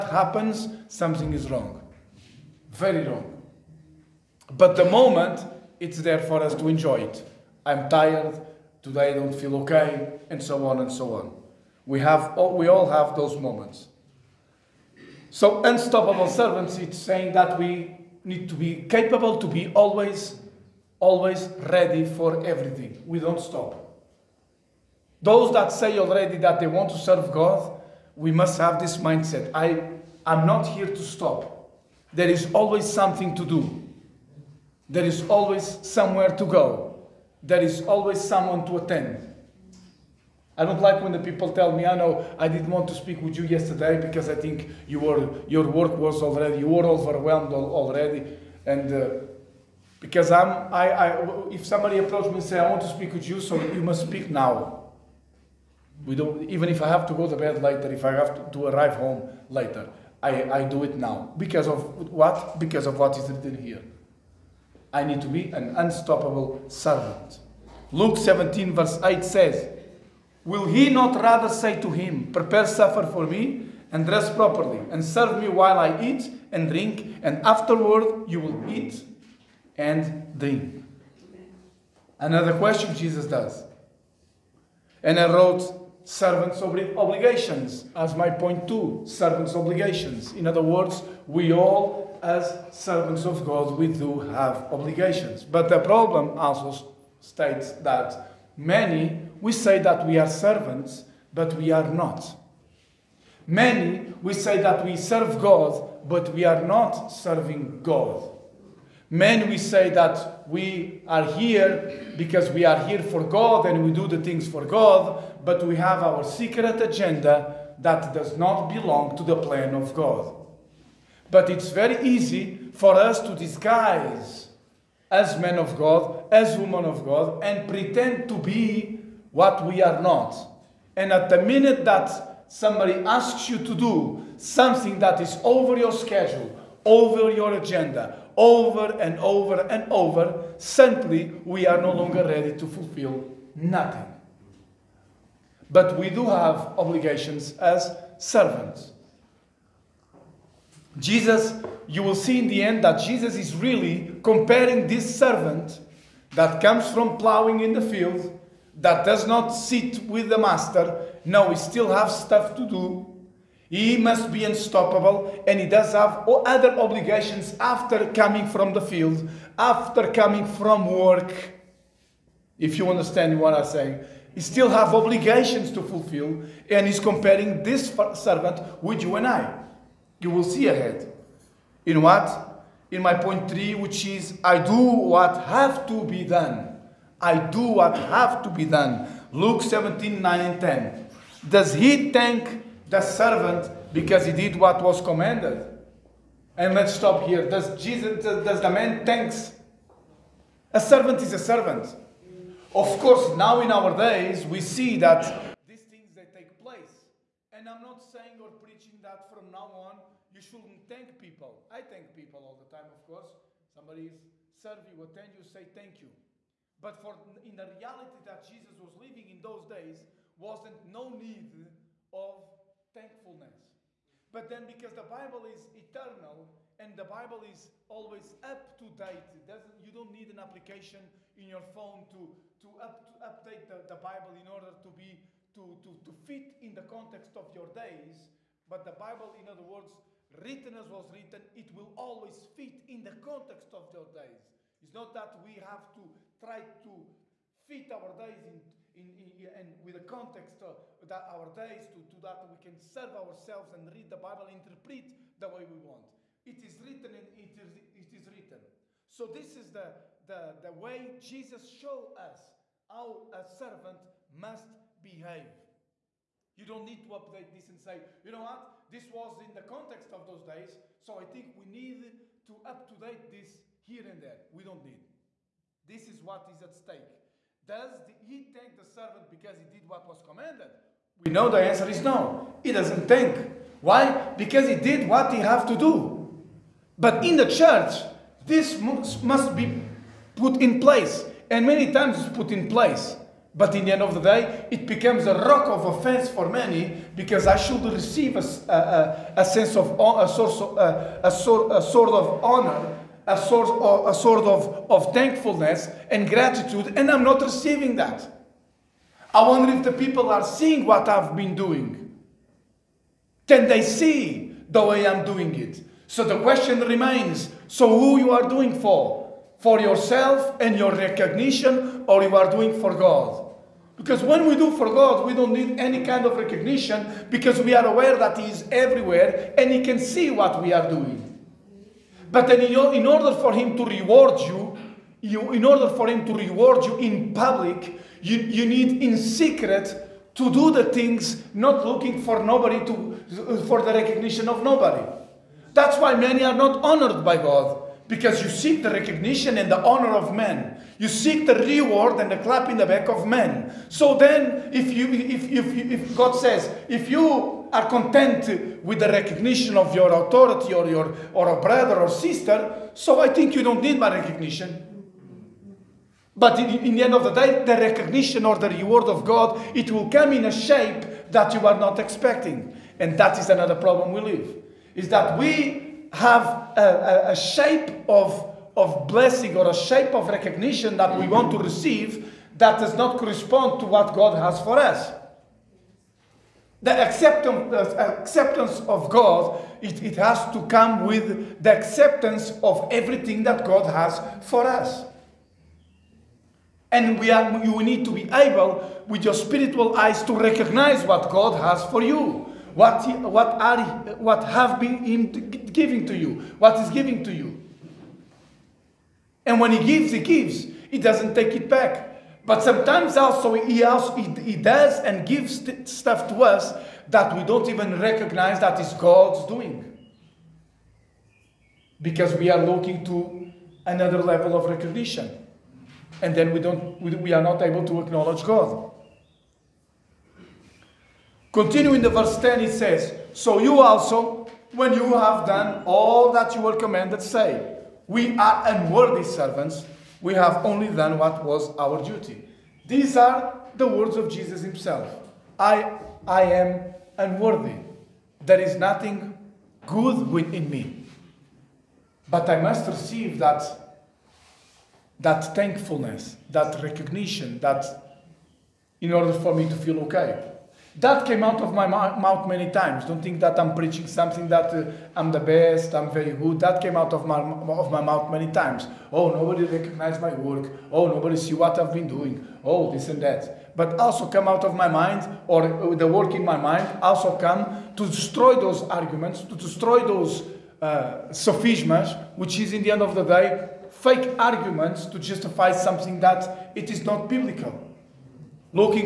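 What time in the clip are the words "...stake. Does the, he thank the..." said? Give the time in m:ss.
4:36.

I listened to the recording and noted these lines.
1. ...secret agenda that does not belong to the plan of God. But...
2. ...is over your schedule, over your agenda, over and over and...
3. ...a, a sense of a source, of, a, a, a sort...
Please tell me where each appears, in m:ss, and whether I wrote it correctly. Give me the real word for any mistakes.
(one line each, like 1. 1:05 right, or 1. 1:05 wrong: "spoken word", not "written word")
1. 1:56 right
2. 2:15 right
3. 4:59 right.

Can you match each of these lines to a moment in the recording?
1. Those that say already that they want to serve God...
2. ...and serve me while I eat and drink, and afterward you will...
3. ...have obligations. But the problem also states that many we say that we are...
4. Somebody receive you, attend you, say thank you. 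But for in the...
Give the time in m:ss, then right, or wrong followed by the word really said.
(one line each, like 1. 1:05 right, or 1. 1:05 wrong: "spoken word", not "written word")
1. 0:25 right
2. 1:14 right
3. 1:34 right
4. 3:33 wrong: "serve", not "receive".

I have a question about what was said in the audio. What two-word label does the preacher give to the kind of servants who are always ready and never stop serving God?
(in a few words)
Unstoppable servants.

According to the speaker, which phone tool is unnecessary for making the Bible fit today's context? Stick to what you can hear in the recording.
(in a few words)
An application.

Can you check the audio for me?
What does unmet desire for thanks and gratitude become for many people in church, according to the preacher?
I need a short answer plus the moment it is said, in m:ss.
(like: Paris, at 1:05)
A rock of offense, at 4:55.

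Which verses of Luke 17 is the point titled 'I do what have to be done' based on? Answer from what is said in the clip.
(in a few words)
9 and 10.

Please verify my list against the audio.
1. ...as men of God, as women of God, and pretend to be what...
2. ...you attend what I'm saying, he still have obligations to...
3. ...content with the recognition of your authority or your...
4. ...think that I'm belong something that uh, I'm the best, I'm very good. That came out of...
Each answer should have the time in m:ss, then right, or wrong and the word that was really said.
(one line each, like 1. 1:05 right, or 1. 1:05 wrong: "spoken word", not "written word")
1. 2:05 right
2. 2:52 wrong: "understand", not "attend"
3. 5:57 right
4. 7:43 wrong: "preaching", not "belong".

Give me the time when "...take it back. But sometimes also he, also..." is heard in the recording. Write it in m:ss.
6:51.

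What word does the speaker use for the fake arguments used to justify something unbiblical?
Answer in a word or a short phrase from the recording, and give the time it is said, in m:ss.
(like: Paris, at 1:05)
Sophisms, at 8:01.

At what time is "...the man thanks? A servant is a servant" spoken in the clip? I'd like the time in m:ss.
3:18.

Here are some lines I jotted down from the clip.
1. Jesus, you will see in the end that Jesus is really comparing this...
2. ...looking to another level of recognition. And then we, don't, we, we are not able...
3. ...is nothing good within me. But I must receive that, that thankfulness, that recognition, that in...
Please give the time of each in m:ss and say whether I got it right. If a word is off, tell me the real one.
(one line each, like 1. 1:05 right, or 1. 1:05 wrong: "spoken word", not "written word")
1. 2:30 right
2. 7:02 right
3. 7:28 right.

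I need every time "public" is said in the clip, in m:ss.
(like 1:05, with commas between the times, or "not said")
5:37.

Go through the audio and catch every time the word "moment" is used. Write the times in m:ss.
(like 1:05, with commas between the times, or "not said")
0:04, 0:13.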